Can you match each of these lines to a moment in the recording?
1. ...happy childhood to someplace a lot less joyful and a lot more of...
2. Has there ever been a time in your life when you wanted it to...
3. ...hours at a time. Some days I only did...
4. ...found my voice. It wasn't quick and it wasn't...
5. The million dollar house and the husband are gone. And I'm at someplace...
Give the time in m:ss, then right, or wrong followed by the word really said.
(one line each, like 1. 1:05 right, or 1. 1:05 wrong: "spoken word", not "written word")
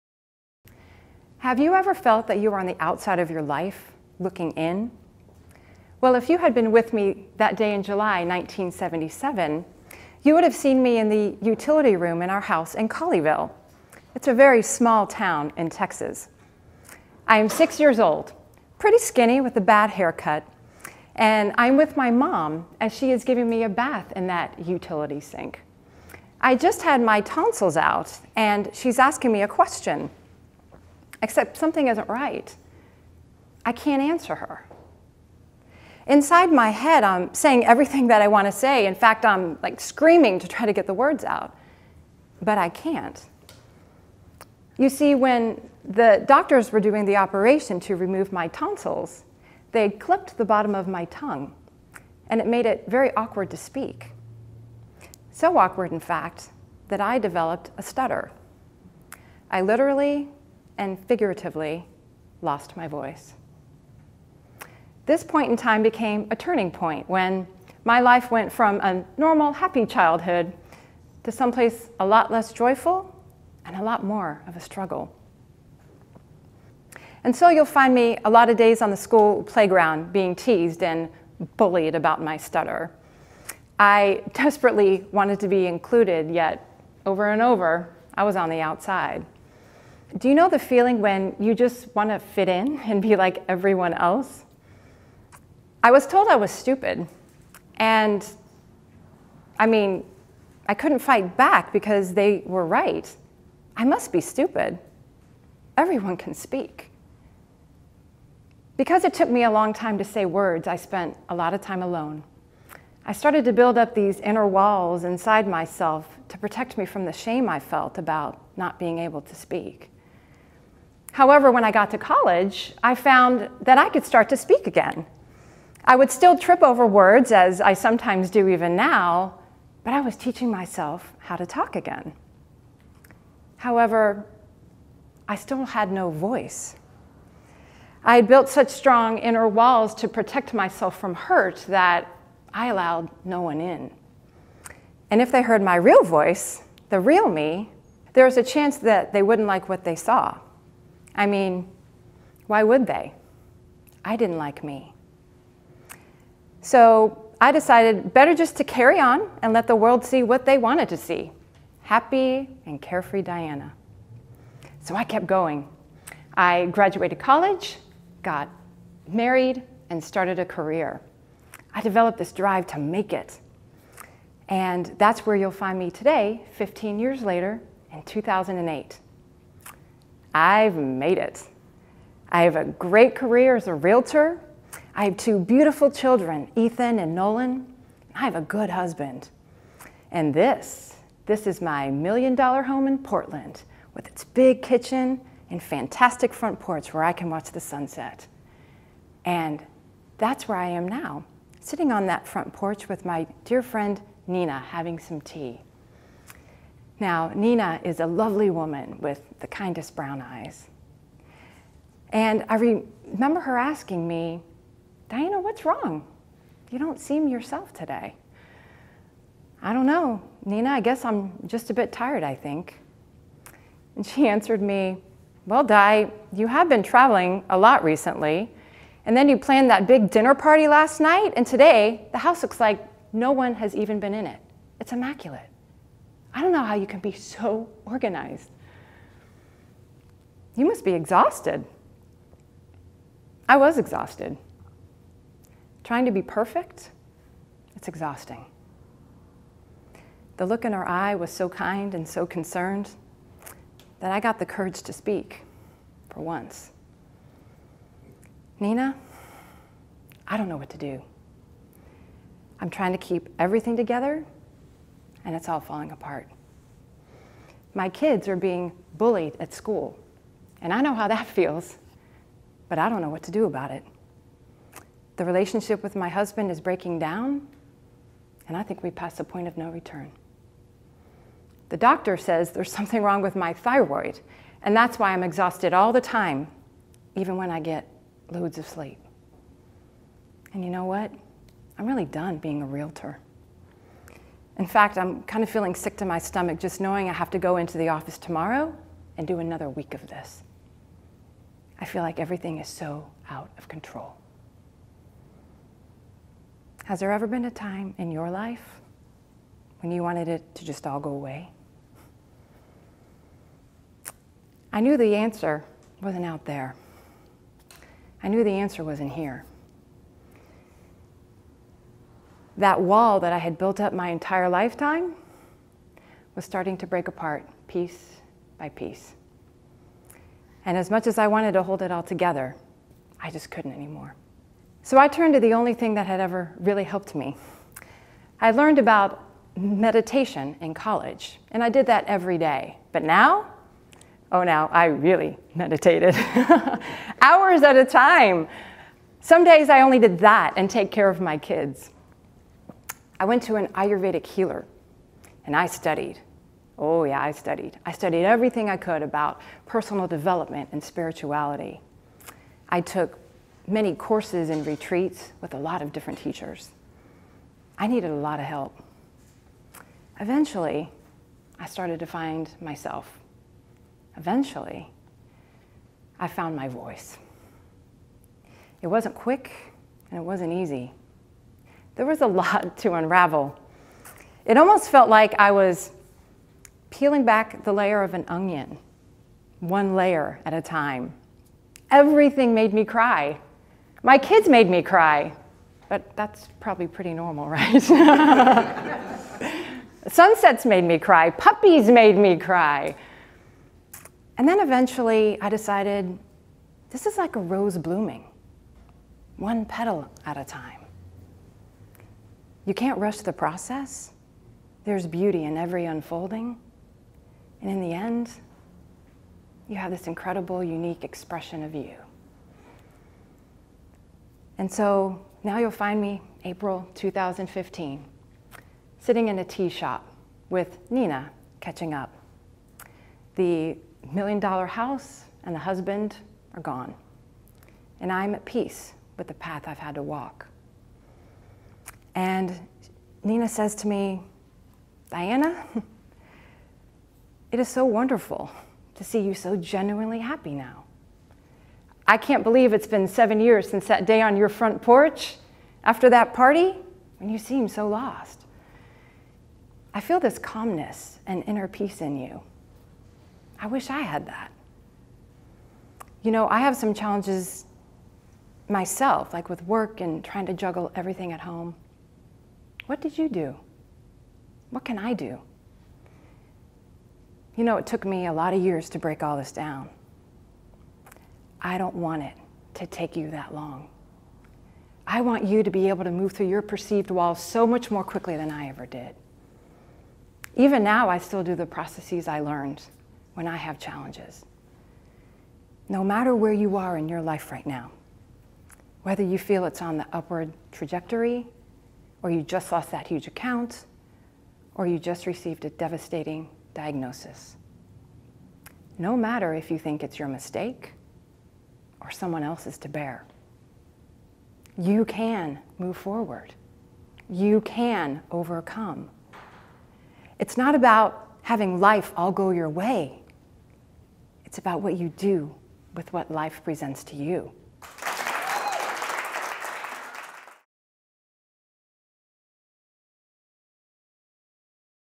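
1. 1:09 right
2. 5:06 right
3. 5:47 right
4. 6:16 right
5. 7:13 wrong: "peace", not "someplace".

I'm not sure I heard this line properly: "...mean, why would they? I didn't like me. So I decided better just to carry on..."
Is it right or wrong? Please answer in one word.
right.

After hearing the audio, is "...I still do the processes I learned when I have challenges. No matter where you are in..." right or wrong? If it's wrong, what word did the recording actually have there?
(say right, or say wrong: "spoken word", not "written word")
right.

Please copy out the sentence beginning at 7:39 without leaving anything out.
I feel this calmness and inner peace in you.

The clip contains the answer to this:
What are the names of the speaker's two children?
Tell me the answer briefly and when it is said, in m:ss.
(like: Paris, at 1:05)
Ethan and Nolan, at 3:06.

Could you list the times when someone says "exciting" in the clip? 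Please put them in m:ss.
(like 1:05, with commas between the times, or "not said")
not said.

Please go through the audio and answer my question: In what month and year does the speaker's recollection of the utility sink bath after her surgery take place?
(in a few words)
July 1977.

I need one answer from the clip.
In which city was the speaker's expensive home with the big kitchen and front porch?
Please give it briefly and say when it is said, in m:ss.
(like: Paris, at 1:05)
Portland, at 3:12.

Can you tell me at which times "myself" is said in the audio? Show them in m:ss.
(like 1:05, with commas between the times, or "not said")
1:55, 2:10, 2:20, 6:12, 7:48.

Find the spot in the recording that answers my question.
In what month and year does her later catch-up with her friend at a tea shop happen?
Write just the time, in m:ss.
7:06.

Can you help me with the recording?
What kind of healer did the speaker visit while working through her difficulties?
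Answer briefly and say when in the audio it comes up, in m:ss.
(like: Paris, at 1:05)
Ayurvedic healer, at 5:53.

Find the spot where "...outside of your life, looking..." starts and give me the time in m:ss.
0:02.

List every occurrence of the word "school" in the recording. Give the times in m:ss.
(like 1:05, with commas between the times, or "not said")
1:18, 4:29.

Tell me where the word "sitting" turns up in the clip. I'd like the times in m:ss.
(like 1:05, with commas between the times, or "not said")
3:21, 7:08.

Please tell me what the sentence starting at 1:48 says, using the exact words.
Because it took me a long time to say words, I spent a lot of time alone.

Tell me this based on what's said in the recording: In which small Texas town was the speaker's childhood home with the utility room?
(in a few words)
Colleyville.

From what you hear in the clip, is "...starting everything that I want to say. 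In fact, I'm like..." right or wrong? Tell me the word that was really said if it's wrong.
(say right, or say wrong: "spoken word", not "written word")
wrong: "saying", not "starting".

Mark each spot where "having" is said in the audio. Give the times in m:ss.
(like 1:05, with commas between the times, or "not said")
3:24, 8:41.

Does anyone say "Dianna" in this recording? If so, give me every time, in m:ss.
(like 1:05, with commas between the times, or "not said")
2:43, 3:35, 7:25.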